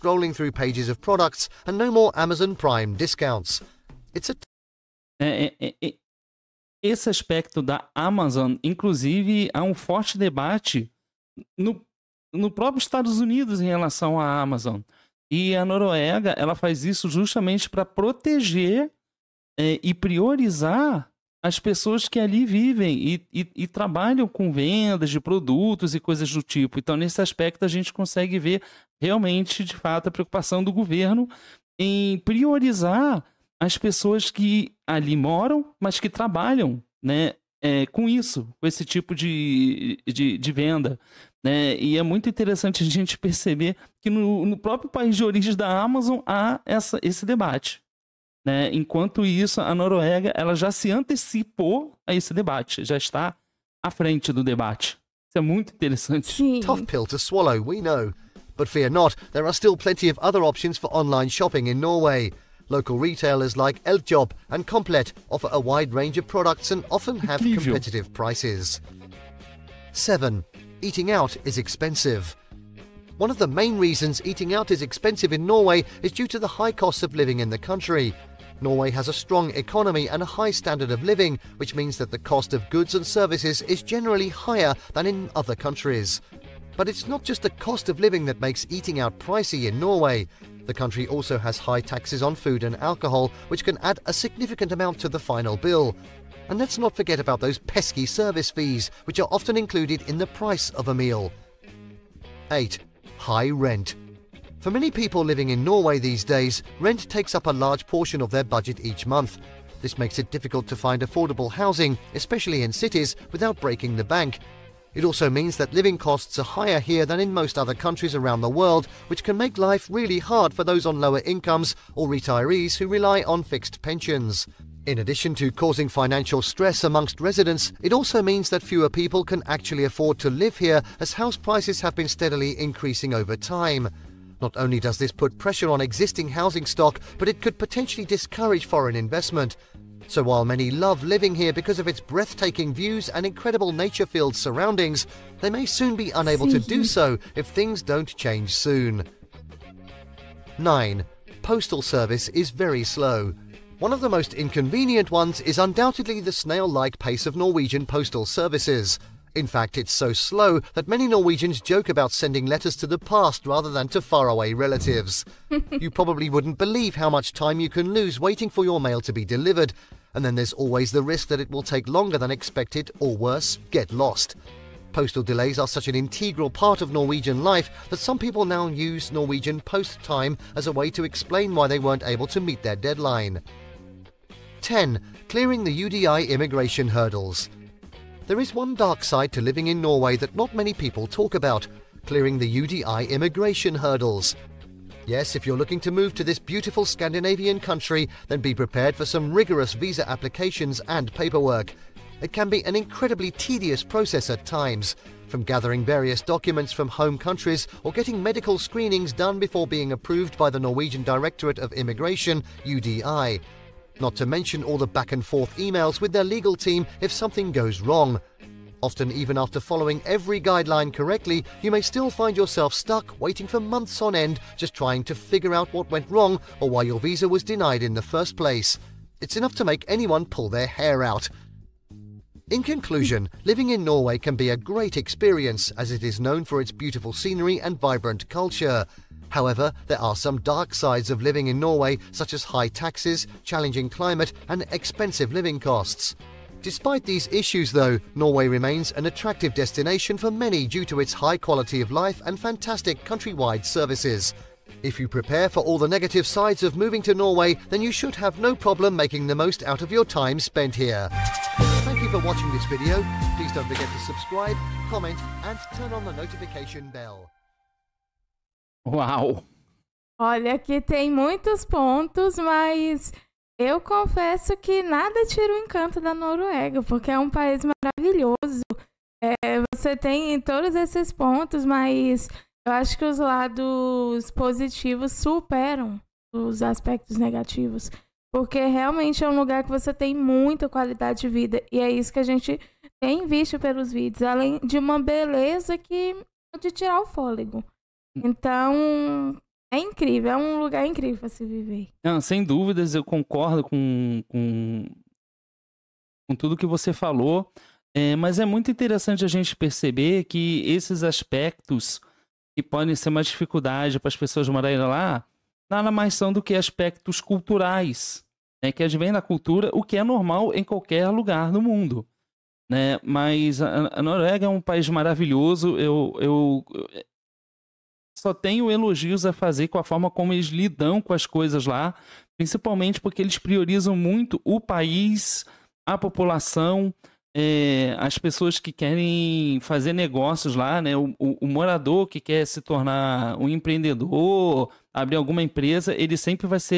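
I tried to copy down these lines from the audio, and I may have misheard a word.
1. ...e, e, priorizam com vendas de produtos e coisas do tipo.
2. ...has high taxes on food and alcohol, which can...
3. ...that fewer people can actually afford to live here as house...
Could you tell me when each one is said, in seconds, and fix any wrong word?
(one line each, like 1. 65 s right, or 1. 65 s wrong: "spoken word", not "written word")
1. 23 s wrong: "trabalham", not "priorizam"
2. 91 s right
3. 128 s right.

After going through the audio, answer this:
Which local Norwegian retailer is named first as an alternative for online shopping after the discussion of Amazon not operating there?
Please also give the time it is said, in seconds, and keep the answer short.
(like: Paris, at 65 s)
Eljob, at 63 s.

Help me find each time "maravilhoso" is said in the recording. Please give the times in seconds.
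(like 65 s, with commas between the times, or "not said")
277 s, 324 s.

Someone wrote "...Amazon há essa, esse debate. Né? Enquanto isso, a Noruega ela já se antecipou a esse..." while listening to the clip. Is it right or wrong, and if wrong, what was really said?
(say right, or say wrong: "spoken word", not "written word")
right.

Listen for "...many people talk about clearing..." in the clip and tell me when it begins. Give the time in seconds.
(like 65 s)
190 s.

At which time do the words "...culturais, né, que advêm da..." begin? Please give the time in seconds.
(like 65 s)
317 s.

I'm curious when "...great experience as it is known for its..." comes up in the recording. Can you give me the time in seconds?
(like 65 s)
234 s.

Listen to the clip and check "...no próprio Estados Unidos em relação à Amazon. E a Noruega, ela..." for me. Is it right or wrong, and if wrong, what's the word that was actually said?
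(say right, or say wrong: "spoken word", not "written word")
right.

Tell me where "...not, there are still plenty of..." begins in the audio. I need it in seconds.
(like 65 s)
58 s.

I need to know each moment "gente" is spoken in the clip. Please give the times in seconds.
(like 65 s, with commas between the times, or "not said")
27 s, 42 s, 292 s, 309 s.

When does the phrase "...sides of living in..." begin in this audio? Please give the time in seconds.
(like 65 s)
240 s.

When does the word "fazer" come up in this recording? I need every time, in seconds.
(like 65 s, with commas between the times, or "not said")
329 s, 339 s.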